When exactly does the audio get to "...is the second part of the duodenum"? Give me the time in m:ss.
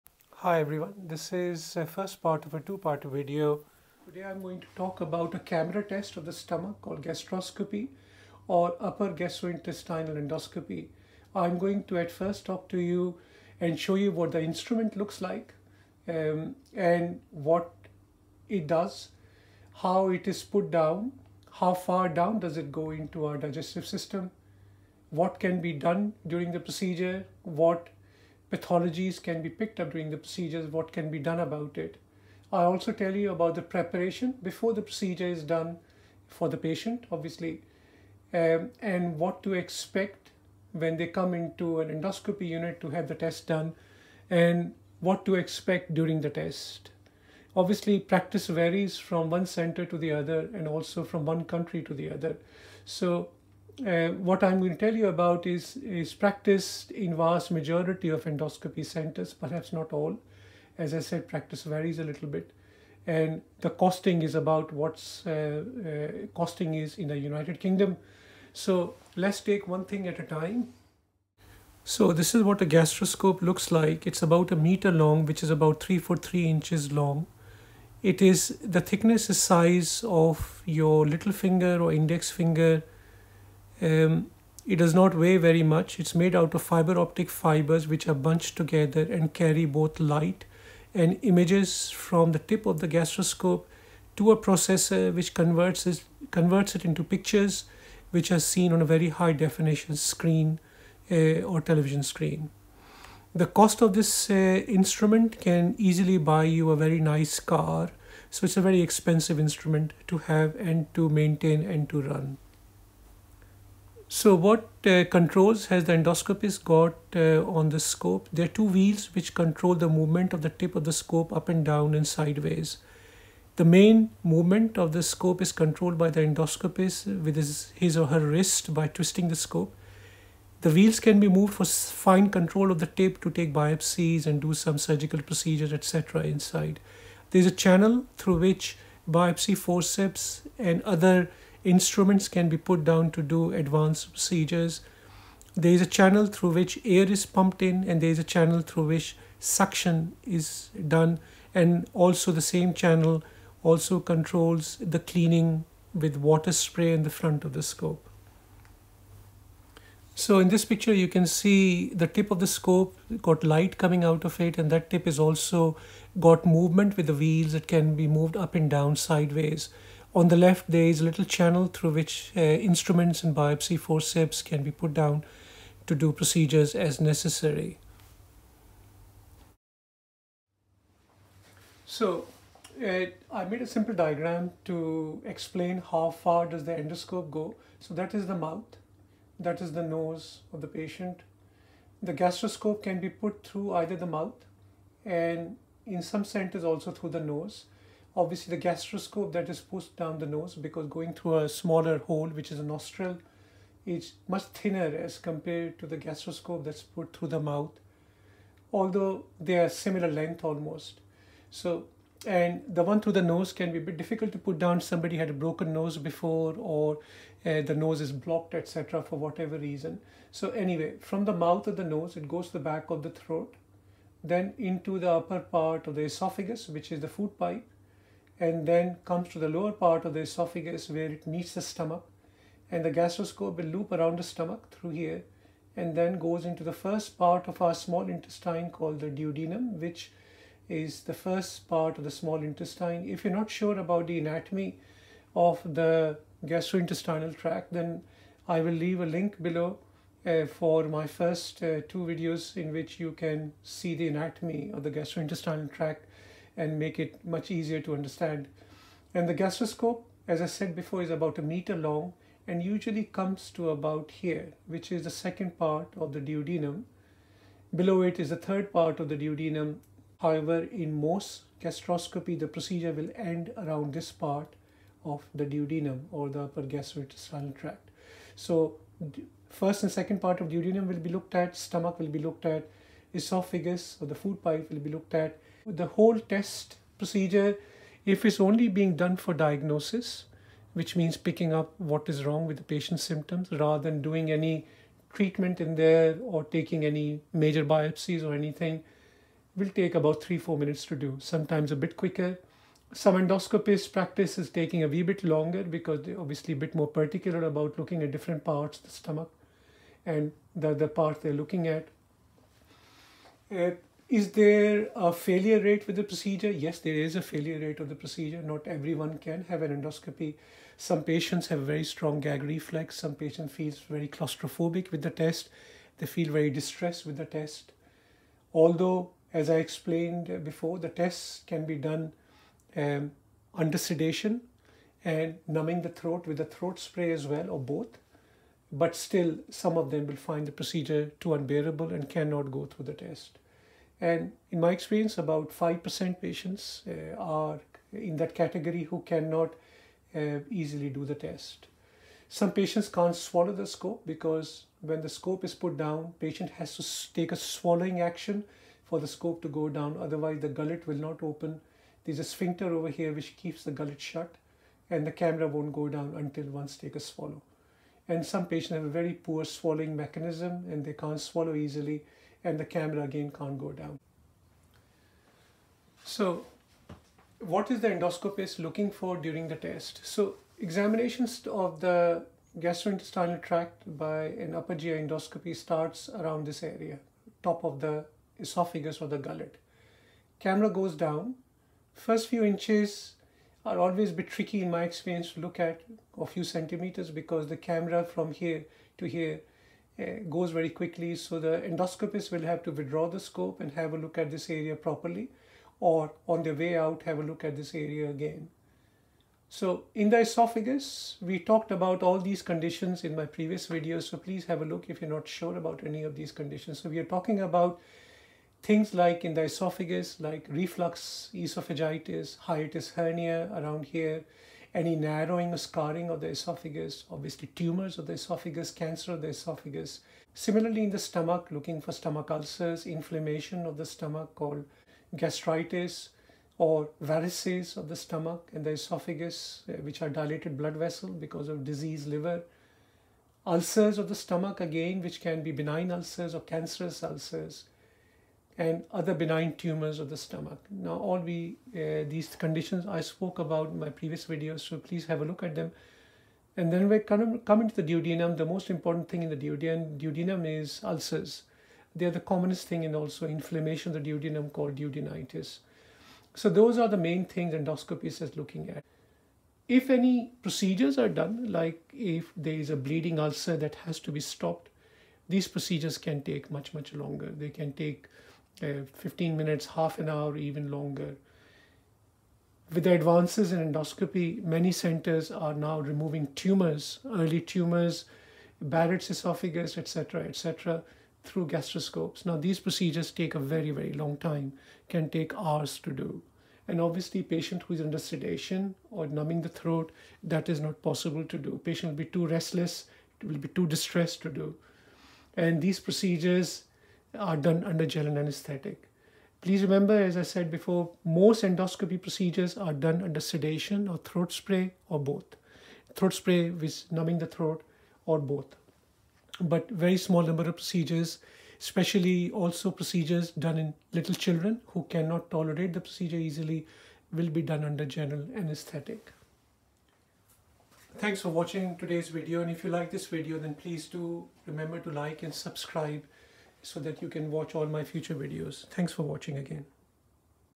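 4:24.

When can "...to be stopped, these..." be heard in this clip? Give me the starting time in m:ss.
7:54.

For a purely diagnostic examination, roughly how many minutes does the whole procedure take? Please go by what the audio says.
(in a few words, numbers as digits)
3 to 4 minutes.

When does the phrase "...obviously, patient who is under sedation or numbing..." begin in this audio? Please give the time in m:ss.
8:16.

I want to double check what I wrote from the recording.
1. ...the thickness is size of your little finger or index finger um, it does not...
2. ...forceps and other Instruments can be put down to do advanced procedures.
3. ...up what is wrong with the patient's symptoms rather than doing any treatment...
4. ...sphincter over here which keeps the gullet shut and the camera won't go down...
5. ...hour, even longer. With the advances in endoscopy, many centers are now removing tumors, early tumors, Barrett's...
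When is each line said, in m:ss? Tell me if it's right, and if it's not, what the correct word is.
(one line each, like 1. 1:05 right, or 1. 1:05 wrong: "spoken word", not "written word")
1. 1:18 right
2. 2:19 right
3. 4:51 right
4. 6:02 right
5. 8:00 right.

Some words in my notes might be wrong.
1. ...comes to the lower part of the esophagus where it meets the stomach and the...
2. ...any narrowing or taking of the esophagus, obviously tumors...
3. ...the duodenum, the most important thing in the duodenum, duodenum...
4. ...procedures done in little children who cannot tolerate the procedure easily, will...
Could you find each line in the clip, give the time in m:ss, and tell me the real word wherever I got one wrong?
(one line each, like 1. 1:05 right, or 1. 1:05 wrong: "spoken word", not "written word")
1. 3:49 right
2. 7:04 wrong: "scarring", not "taking"
3. 7:37 right
4. 8:42 right.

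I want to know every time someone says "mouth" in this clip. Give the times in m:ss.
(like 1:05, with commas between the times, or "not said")
3:08, 3:14, 3:27, 3:41.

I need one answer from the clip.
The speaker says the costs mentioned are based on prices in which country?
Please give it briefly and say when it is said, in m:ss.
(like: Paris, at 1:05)
United Kingdom, at 1:07.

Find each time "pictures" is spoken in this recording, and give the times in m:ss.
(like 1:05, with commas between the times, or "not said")
1:37, 2:40.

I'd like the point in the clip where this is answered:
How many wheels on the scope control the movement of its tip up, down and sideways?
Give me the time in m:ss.
1:58.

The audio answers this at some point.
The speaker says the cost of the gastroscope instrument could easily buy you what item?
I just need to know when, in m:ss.
1:46.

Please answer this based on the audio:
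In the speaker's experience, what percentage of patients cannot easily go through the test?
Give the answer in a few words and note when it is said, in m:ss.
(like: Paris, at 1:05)
5%, at 5:45.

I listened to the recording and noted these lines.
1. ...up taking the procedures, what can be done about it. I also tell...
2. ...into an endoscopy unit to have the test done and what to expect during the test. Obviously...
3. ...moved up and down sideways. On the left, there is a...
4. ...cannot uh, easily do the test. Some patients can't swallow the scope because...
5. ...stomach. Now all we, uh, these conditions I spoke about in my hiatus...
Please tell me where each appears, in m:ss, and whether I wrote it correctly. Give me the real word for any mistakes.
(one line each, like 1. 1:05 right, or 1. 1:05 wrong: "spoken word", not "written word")
1. 0:29 wrong: "during", not "taking"
2. 0:41 right
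3. 2:48 right
4. 5:49 right
5. 7:30 wrong: "previous", not "hiatus".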